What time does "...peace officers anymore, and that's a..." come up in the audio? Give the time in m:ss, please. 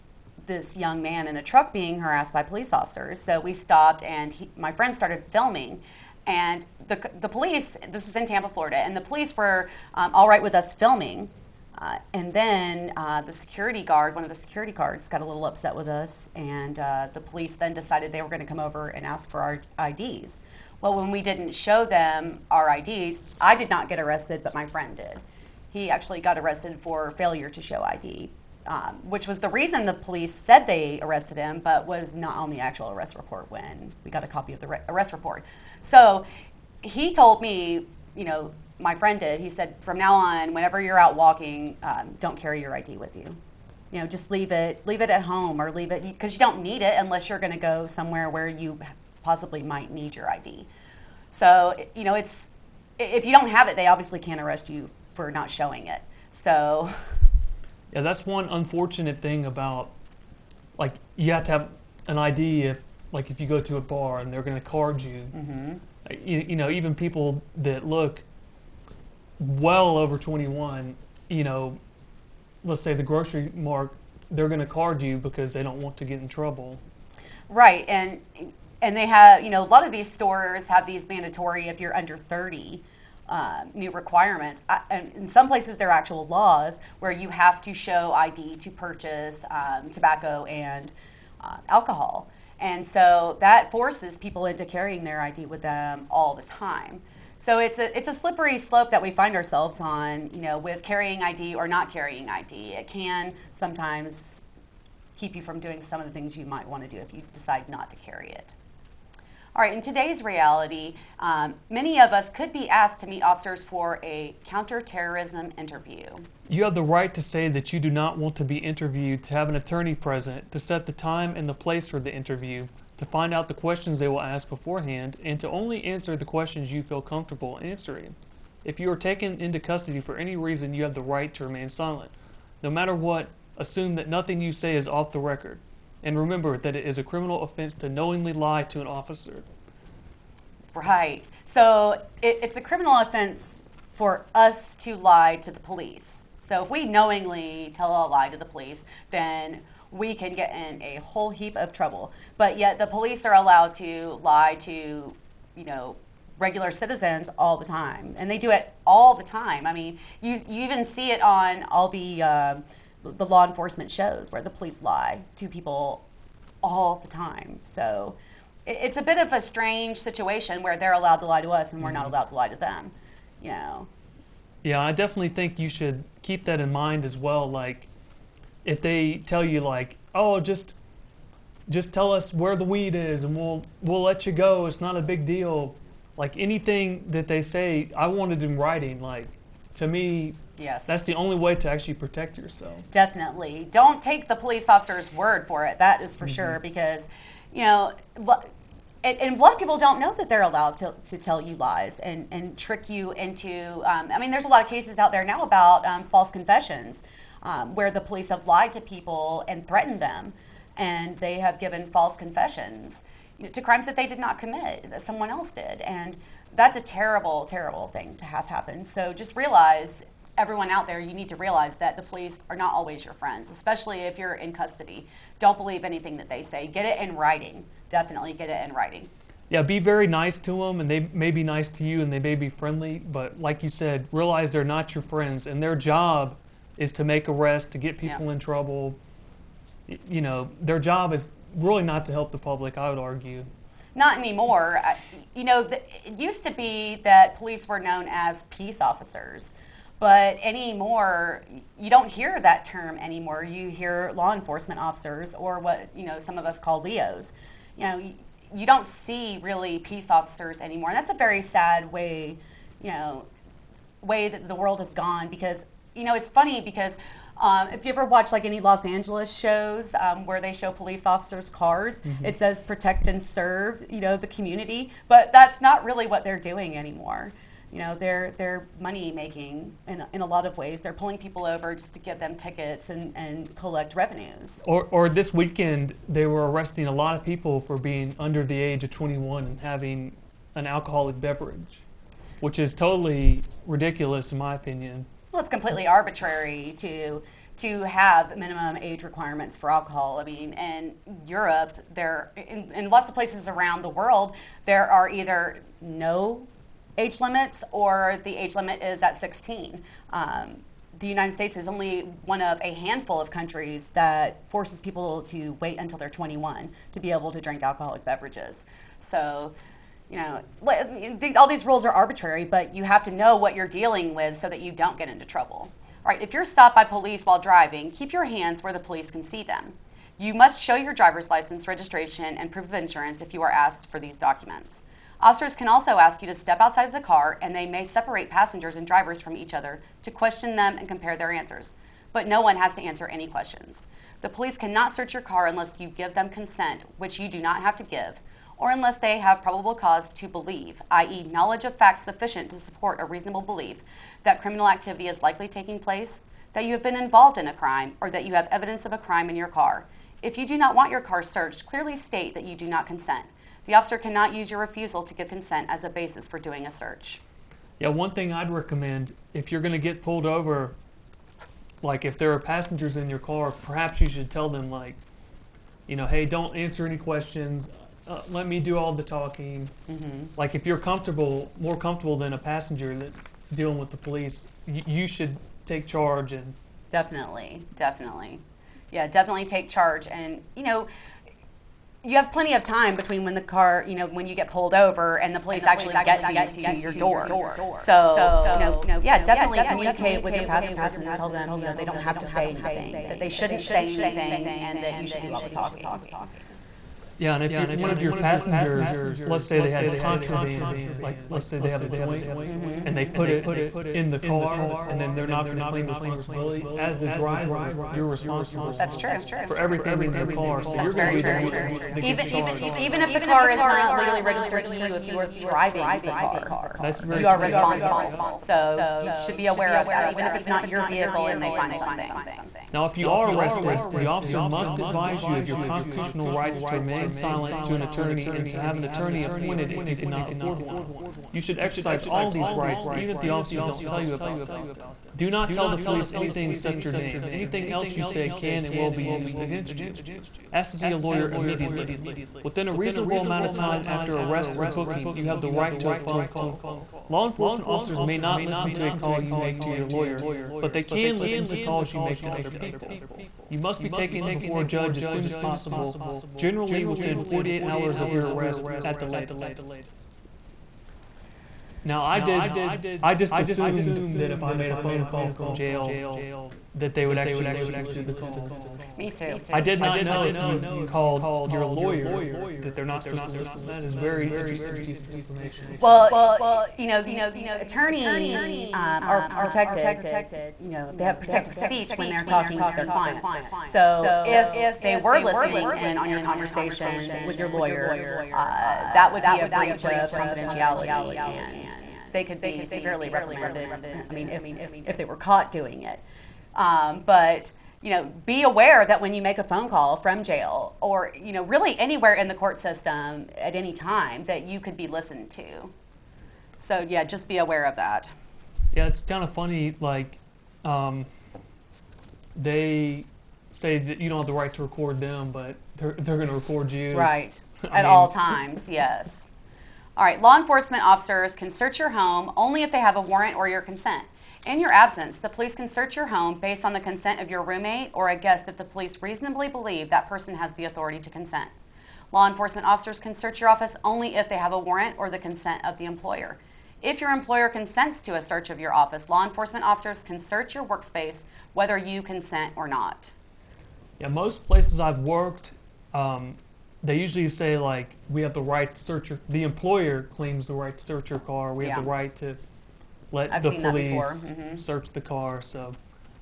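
4:19.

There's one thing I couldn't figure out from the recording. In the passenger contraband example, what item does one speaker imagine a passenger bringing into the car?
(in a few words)
a joint.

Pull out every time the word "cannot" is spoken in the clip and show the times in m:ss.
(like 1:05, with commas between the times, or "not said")
5:44, 6:03, 7:19.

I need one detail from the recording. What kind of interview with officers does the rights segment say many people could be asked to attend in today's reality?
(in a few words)
counterterrorism interview.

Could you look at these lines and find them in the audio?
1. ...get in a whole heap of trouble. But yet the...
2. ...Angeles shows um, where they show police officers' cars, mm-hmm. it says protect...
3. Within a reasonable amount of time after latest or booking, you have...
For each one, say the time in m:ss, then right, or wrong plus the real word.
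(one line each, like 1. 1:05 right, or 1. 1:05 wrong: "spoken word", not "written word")
1. 2:30 right
2. 4:28 right
3. 7:32 wrong: "arrest", not "latest".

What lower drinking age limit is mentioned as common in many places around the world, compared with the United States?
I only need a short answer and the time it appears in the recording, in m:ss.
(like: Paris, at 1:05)
16, at 5:09.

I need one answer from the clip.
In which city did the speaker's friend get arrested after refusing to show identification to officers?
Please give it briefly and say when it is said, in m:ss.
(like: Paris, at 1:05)
Tampa, Florida, at 0:08.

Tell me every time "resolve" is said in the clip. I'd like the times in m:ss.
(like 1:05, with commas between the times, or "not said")
not said.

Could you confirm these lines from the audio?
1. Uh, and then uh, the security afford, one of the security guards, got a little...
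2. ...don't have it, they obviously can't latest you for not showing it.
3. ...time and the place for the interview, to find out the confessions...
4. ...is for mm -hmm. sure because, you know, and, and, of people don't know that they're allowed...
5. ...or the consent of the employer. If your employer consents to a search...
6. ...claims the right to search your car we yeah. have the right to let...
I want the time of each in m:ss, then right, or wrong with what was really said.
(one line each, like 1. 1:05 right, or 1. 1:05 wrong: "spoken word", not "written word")
1. 0:11 wrong: "guard", not "afford"
2. 0:53 wrong: "arrest", not "latest"
3. 2:00 wrong: "questions", not "confessions"
4. 3:16 right
5. 9:04 right
6. 9:20 right.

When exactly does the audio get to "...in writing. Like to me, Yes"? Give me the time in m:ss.
3:08.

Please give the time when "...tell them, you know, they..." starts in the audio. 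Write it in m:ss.
6:41.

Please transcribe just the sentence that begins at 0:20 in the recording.
Well, when we didn't show them our IDs, I did not get arrested, but my friend did.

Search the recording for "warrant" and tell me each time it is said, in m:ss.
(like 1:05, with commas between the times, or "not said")
8:53, 9:04.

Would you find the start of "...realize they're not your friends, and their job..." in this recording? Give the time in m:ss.
3:54.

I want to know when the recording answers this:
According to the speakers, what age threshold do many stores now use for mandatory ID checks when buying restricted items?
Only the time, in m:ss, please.
1:21.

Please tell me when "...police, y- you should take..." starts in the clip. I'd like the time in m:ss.
6:23.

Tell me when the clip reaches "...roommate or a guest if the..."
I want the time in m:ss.
8:57.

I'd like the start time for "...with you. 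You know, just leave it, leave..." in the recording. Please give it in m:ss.
0:42.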